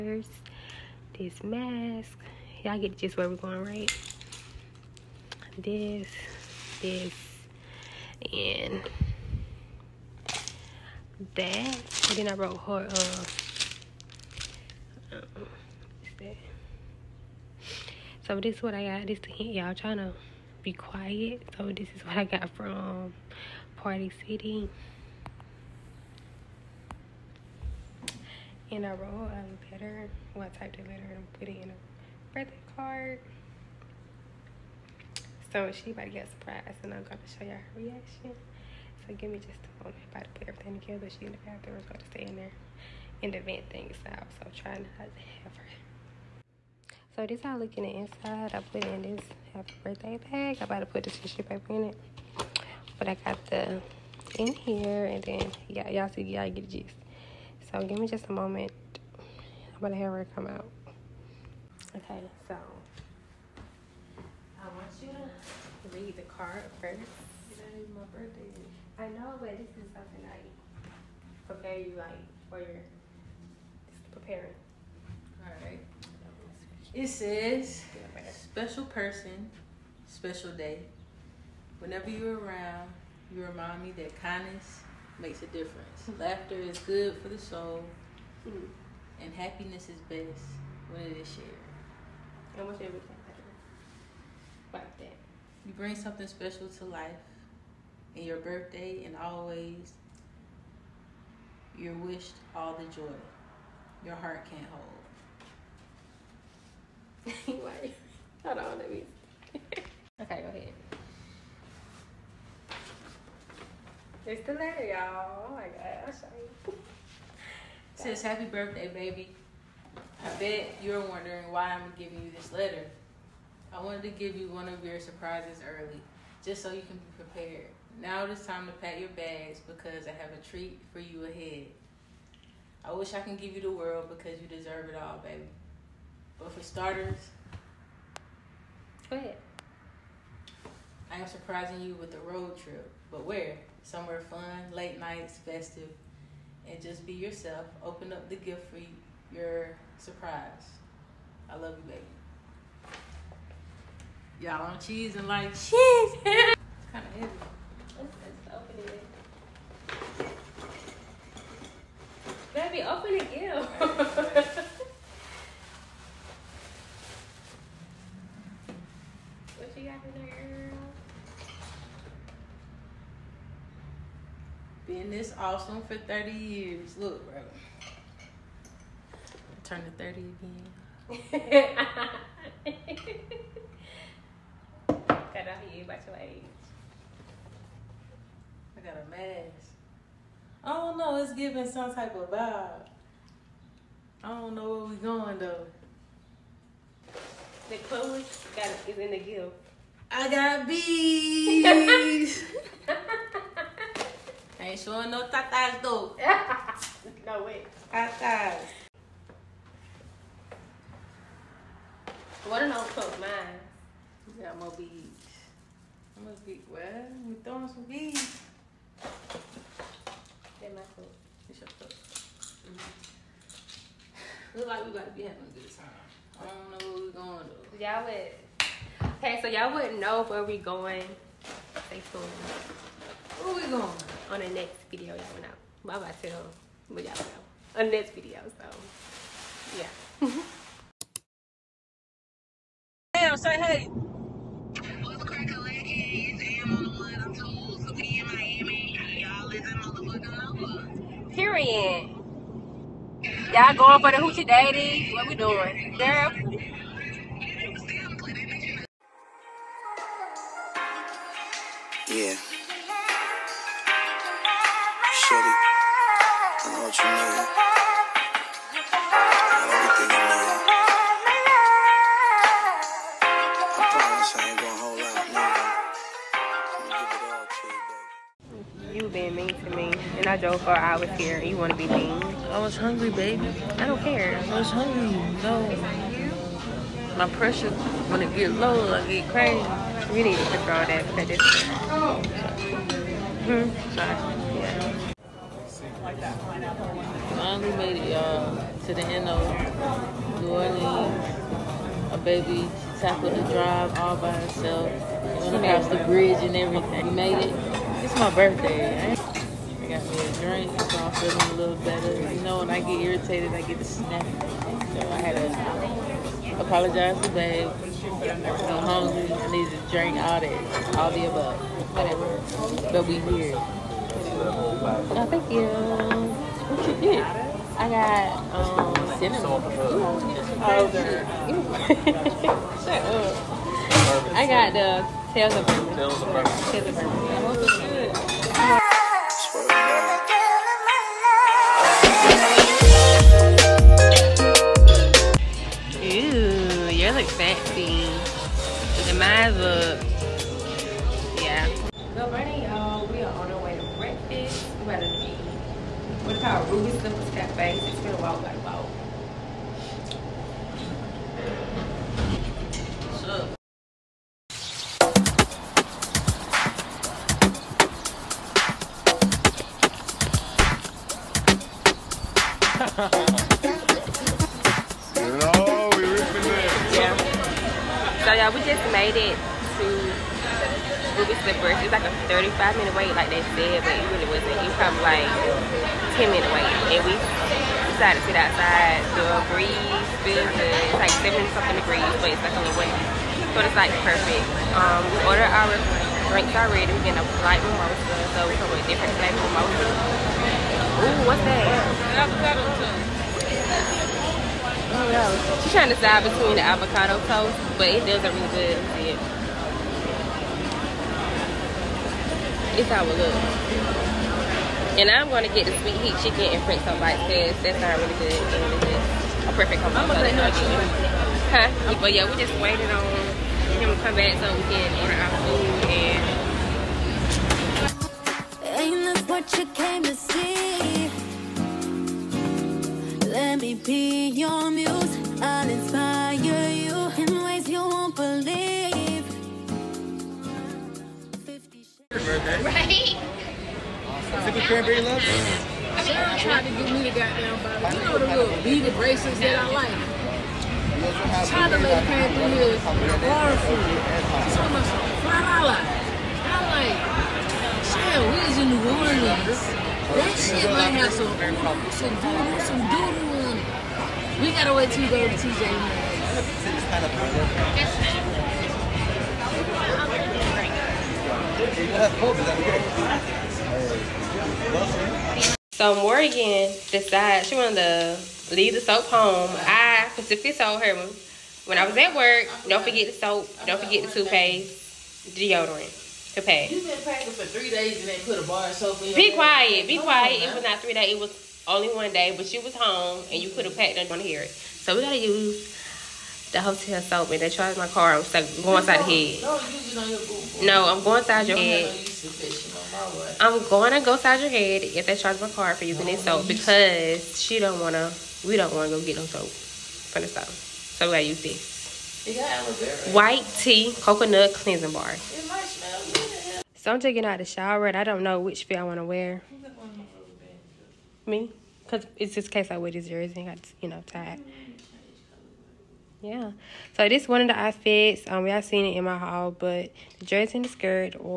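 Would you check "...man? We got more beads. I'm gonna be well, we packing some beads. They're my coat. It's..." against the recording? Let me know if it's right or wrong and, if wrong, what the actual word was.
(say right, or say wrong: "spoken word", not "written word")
wrong: "throwing", not "packing".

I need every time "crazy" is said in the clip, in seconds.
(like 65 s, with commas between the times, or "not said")
289 s.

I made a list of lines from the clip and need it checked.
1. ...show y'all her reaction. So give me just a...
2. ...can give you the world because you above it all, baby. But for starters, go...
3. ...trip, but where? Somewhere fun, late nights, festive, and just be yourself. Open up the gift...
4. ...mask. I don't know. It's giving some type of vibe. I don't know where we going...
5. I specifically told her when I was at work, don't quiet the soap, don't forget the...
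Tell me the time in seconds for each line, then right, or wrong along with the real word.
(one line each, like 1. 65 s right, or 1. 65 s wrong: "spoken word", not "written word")
1. 37 s right
2. 133 s wrong: "deserve", not "above"
3. 142 s right
4. 189 s right
5. 479 s wrong: "forget", not "quiet".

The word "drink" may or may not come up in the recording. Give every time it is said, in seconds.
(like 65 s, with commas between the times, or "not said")
310 s, 319 s, 396 s.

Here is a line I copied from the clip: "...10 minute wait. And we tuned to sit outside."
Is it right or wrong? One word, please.
wrong.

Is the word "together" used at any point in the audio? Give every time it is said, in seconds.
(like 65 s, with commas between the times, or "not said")
40 s.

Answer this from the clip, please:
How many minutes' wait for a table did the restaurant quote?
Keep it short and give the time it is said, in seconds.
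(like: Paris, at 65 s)
35 minutes, at 382 s.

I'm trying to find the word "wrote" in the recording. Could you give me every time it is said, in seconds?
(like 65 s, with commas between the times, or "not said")
12 s, 28 s.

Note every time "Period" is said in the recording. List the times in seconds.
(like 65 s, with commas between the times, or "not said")
251 s.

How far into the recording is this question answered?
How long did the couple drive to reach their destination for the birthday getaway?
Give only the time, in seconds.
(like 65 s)
280 s.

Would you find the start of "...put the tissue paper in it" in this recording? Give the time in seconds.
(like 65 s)
50 s.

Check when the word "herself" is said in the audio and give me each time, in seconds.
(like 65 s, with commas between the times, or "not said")
304 s.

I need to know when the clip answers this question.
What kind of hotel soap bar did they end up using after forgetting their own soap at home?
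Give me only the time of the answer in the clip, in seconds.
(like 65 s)
513 s.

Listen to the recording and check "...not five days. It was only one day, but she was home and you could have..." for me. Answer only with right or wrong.
wrong.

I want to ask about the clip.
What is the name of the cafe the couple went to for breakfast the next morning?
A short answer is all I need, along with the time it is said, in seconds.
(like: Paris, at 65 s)
Ruby Slippers Cafe, at 356 s.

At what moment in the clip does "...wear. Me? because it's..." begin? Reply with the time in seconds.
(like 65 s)
519 s.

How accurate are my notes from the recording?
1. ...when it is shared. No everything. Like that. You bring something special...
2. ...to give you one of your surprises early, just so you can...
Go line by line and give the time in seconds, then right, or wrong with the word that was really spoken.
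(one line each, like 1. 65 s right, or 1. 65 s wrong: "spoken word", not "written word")
1. 90 s right
2. 124 s right.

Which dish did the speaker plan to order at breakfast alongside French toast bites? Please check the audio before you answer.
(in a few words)
sweet heat chicken.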